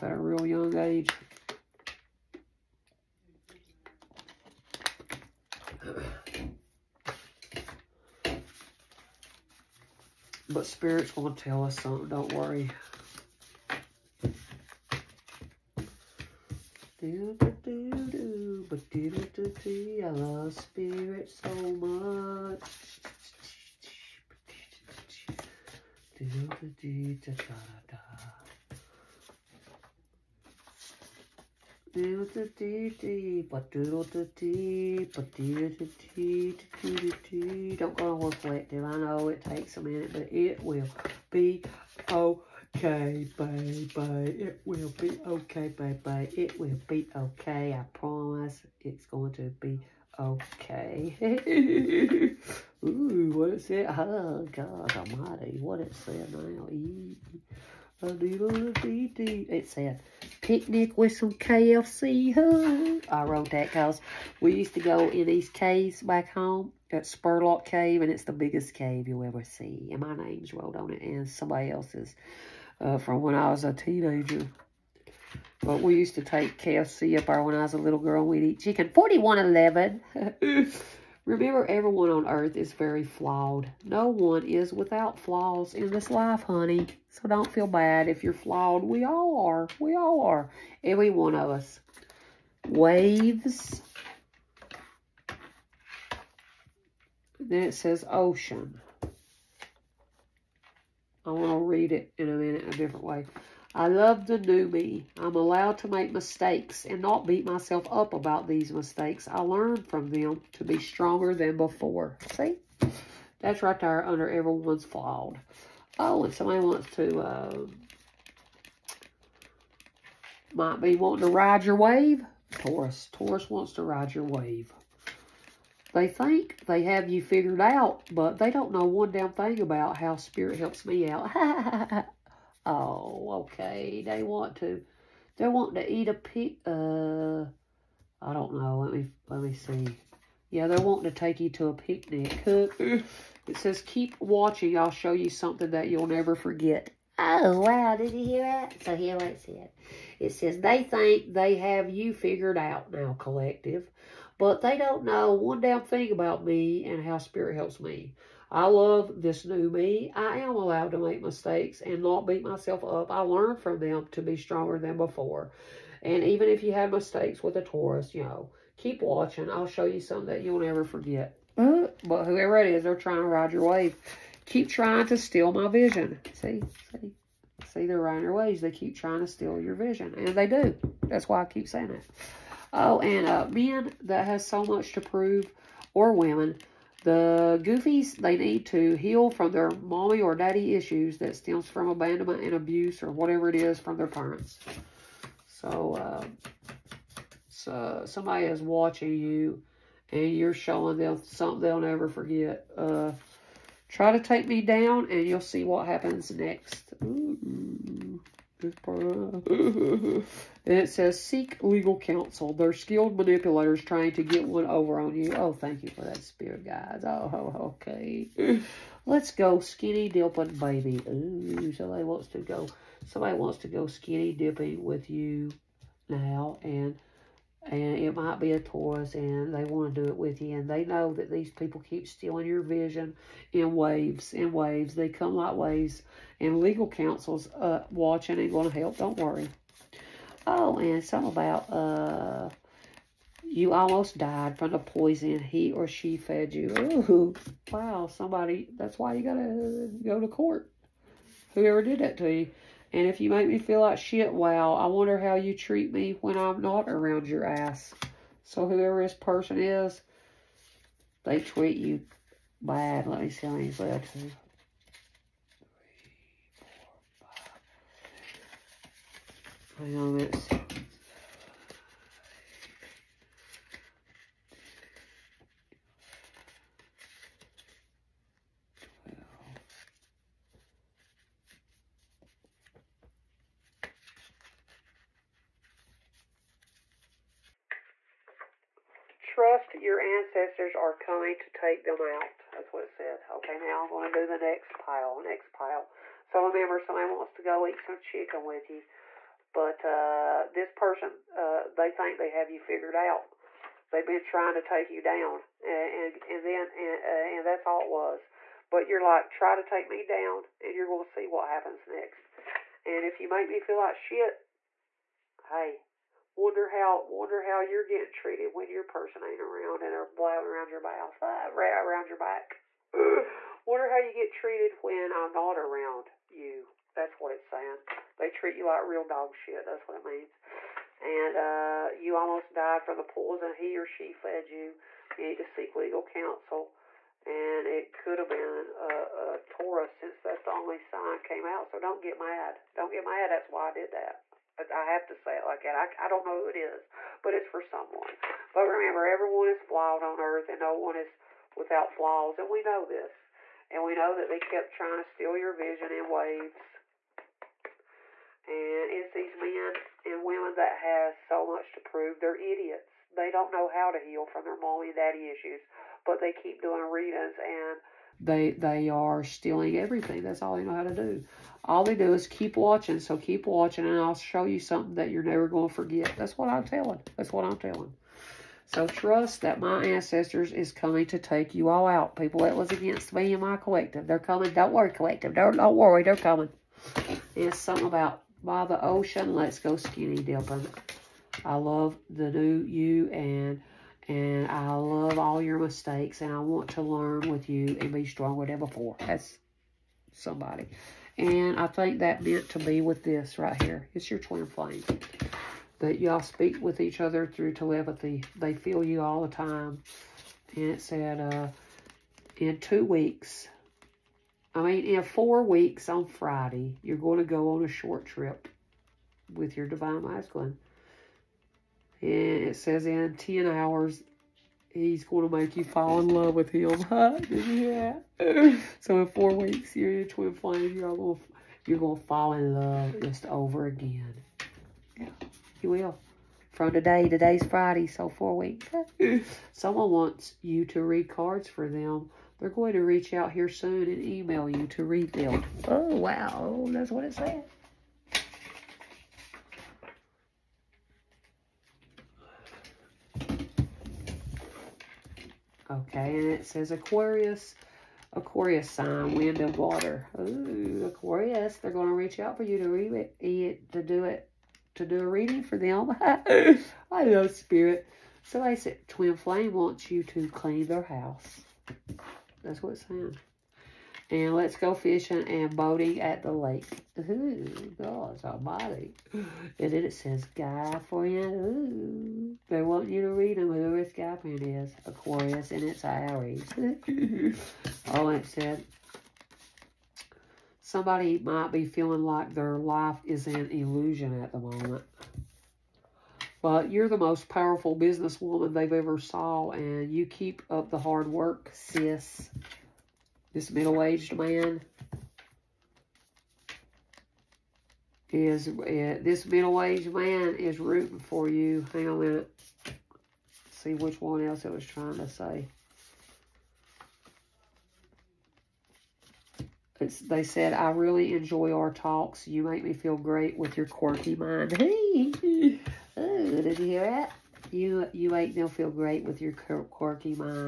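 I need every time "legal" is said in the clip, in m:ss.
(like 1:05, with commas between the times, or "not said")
3:31, 3:56, 5:35.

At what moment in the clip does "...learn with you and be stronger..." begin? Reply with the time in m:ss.
6:36.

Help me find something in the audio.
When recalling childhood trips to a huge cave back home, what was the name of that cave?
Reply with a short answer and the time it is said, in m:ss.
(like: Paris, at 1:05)
Spurlock Cave, at 1:07.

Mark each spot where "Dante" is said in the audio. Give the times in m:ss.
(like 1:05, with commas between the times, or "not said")
not said.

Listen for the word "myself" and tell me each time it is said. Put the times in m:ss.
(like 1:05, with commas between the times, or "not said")
1:47, 2:42.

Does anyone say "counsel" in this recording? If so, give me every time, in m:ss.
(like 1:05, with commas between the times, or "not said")
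3:31, 3:56, 5:36.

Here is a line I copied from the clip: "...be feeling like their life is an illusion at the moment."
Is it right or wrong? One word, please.
right.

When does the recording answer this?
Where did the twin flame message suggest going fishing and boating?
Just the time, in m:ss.
7:54.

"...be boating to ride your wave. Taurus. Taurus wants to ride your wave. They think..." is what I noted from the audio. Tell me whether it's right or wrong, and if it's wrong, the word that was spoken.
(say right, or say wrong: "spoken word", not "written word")
wrong: "wanting", not "boating".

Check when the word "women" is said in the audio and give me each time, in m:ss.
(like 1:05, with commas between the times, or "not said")
3:06, 6:00.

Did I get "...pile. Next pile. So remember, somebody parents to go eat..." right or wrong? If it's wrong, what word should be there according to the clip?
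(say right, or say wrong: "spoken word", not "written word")
wrong: "wants", not "parents".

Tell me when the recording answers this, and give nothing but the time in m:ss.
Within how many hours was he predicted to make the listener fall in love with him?
7:02.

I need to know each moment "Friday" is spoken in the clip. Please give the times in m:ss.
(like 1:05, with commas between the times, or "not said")
6:56, 7:17.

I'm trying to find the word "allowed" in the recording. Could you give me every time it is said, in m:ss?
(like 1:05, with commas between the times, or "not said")
1:45, 2:40.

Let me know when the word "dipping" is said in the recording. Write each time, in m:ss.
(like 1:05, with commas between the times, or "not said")
3:40, 3:44, 6:30.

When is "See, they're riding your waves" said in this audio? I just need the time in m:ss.
2:57.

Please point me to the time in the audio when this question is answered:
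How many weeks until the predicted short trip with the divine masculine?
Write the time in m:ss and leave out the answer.
6:54.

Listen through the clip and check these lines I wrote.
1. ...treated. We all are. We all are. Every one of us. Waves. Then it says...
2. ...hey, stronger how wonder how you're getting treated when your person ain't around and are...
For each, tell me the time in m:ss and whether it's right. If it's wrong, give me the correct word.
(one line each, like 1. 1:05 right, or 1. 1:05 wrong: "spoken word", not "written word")
1. 1:28 wrong: "flawed", not "treated"
2. 5:15 wrong: "wonder", not "stronger".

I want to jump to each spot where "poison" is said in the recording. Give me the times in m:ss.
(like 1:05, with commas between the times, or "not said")
4:04, 5:33.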